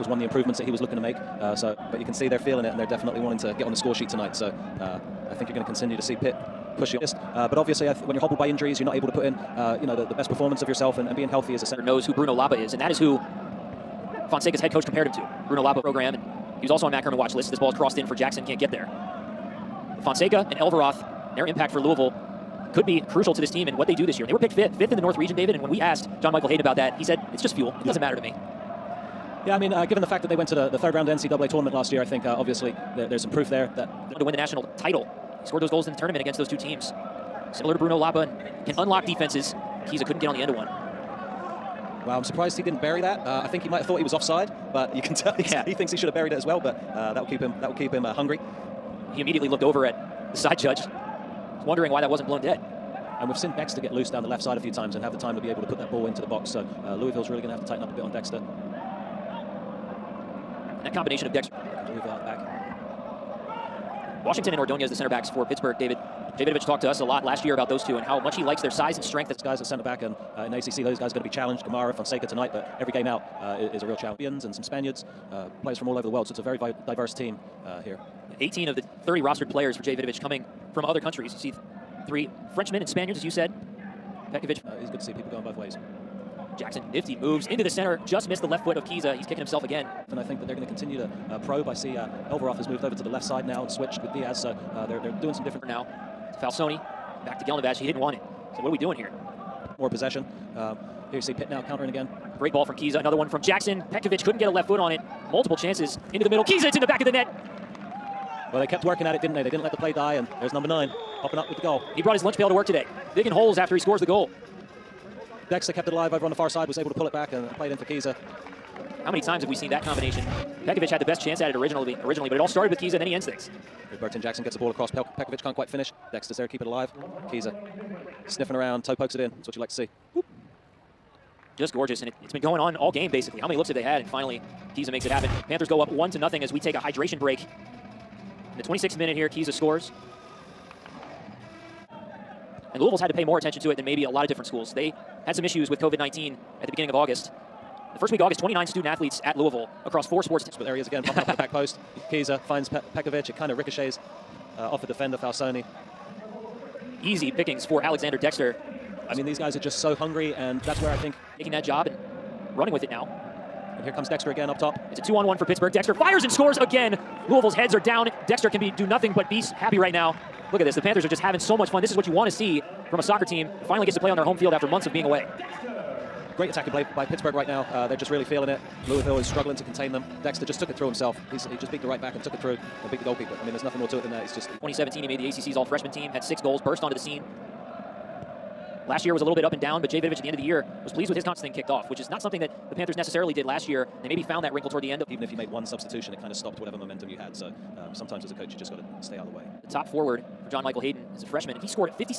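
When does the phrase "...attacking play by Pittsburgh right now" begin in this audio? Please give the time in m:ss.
2:56.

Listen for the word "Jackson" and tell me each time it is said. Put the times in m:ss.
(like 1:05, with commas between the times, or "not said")
0:18, 1:26, 1:43.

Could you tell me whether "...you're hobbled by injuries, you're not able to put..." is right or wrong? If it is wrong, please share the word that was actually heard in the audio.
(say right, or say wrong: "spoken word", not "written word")
right.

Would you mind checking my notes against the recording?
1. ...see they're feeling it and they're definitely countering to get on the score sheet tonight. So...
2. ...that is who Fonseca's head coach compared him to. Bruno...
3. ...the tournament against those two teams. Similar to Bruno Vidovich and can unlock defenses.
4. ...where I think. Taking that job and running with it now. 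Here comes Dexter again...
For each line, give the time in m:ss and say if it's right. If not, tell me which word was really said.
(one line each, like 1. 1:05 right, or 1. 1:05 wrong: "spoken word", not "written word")
1. 0:02 wrong: "wanting", not "countering"
2. 0:12 right
3. 0:35 wrong: "Lapa", not "Vidovich"
4. 2:40 right.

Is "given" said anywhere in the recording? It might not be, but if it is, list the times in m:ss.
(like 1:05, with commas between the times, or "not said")
0:29.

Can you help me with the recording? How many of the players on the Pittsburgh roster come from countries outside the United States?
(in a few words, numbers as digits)
18.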